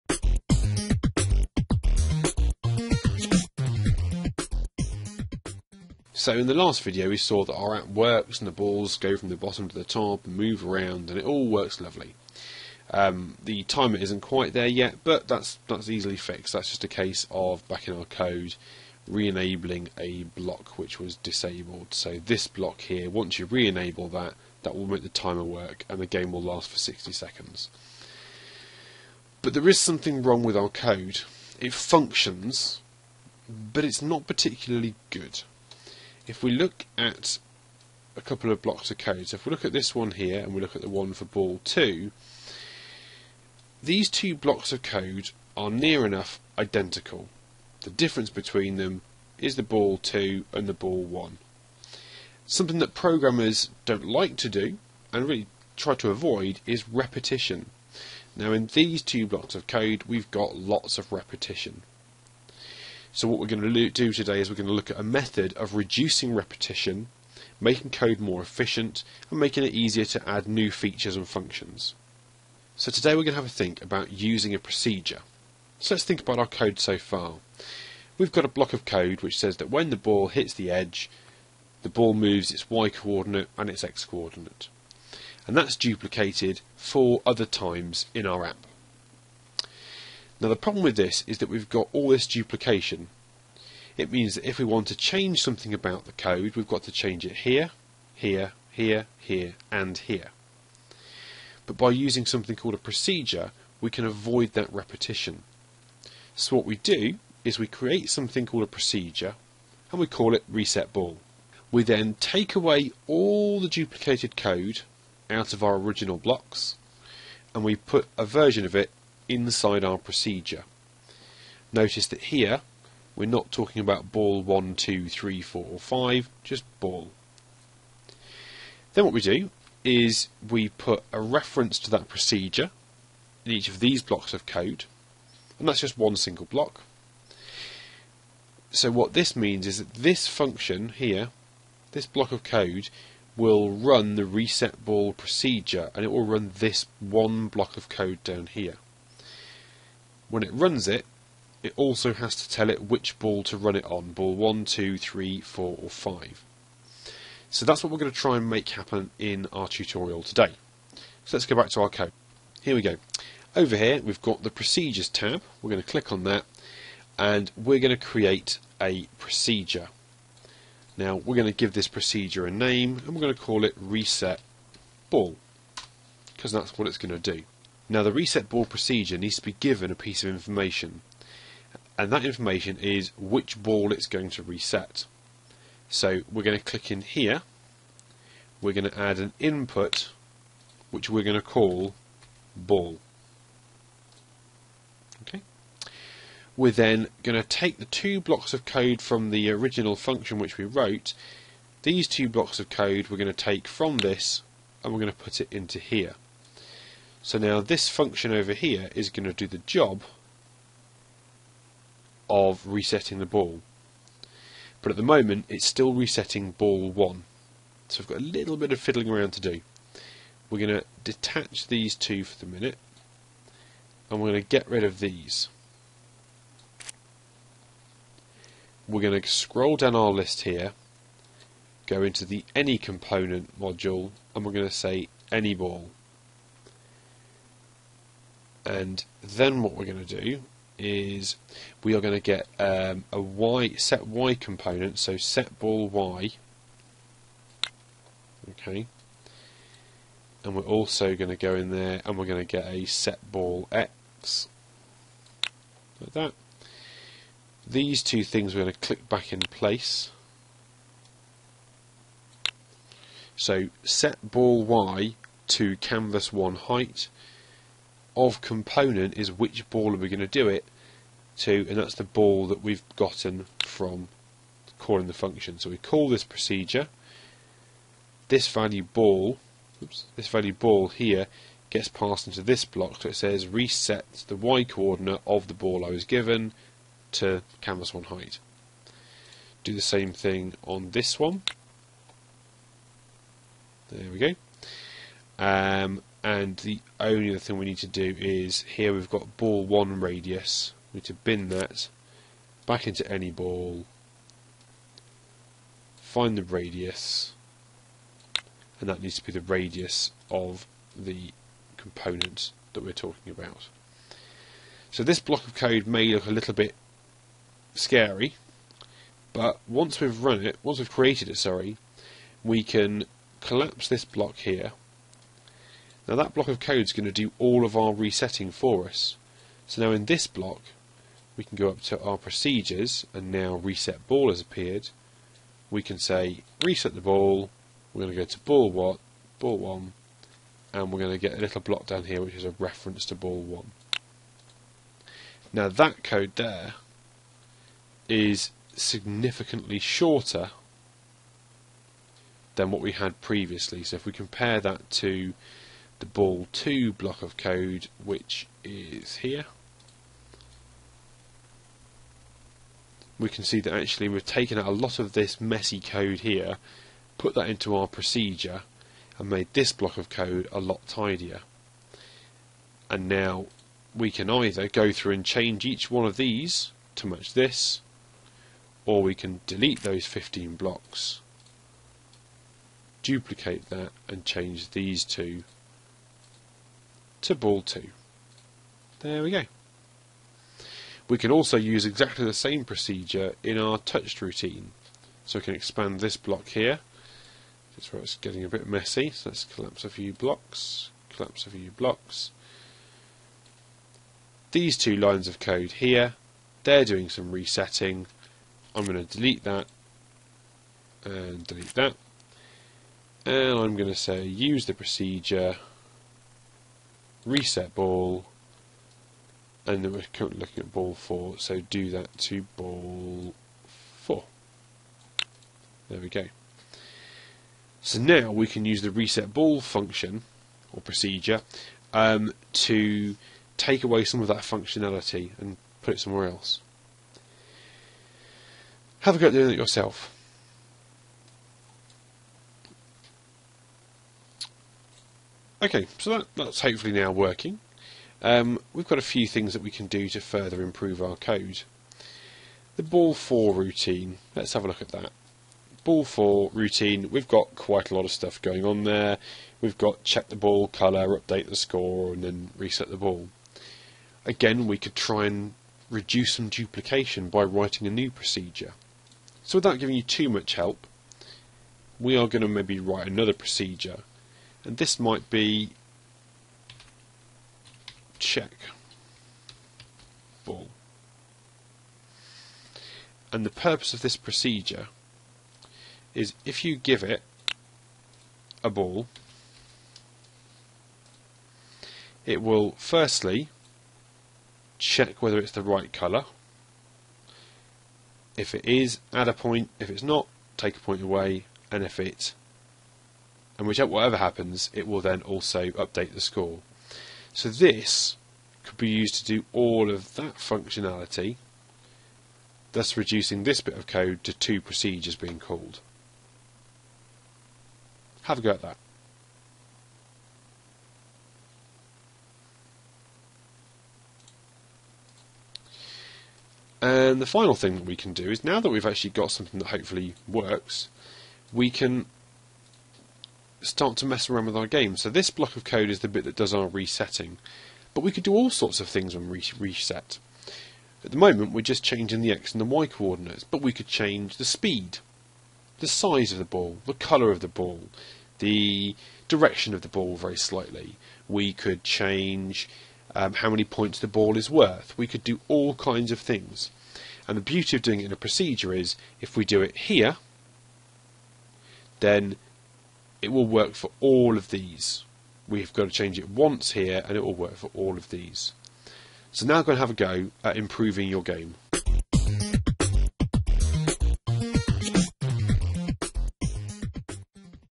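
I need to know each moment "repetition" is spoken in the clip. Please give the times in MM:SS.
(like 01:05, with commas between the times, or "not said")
00:56, 01:01, 01:06, 01:44.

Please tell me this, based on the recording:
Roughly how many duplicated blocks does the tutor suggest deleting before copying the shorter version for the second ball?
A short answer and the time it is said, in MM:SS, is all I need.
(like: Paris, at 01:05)
15, at 06:20.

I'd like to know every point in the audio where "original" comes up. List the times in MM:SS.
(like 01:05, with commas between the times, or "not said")
01:55, 03:19.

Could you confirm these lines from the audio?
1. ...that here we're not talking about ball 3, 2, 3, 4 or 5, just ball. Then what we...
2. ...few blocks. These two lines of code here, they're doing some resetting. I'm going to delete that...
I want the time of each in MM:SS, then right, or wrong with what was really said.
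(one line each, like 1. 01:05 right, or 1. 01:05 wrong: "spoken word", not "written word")
1. 02:02 wrong: "1", not "3"
2. 06:41 right.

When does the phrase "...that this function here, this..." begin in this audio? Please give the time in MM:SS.
02:19.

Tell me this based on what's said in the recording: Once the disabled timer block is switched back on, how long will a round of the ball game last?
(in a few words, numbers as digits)
60 seconds.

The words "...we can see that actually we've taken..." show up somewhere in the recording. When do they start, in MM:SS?
06:03.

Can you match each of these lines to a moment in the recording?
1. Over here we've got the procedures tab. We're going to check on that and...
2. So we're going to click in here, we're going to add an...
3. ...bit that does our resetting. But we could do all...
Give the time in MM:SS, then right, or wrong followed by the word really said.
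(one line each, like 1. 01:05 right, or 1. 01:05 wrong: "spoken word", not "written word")
1. 02:43 wrong: "click", not "check"
2. 03:05 right
3. 08:56 right.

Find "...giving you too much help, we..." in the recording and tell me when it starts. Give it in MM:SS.
07:49.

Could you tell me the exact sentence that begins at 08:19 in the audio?
If it's not, take a point away.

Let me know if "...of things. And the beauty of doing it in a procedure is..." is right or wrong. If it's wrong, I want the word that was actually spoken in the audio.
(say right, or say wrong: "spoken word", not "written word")
right.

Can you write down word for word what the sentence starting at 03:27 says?
So now this function over here is going to do the job of resetting the ball.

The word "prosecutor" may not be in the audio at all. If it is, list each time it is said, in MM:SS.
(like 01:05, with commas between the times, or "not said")
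not said.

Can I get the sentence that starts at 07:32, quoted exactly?
The ball 4 routine, let's have a look at that.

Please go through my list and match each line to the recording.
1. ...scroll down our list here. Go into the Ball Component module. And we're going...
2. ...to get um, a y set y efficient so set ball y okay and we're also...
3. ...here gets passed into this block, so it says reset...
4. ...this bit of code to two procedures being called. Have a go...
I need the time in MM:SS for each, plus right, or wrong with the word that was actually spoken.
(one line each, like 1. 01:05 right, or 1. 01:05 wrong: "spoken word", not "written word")
1. 03:49 wrong: "Any", not "Ball"
2. 04:02 wrong: "component", not "efficient"
3. 04:40 right
4. 08:33 right.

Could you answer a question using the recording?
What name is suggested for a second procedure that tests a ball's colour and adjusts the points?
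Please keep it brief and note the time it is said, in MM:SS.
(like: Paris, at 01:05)
check ball, at 07:58.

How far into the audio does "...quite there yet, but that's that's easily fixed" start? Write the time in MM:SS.
00:14.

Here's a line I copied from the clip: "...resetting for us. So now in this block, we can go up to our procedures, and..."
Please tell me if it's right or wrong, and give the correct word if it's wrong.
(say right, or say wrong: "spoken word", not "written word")
right.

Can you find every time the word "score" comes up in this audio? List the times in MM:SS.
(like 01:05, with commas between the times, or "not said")
07:41, 08:26.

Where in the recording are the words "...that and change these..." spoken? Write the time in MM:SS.
06:23.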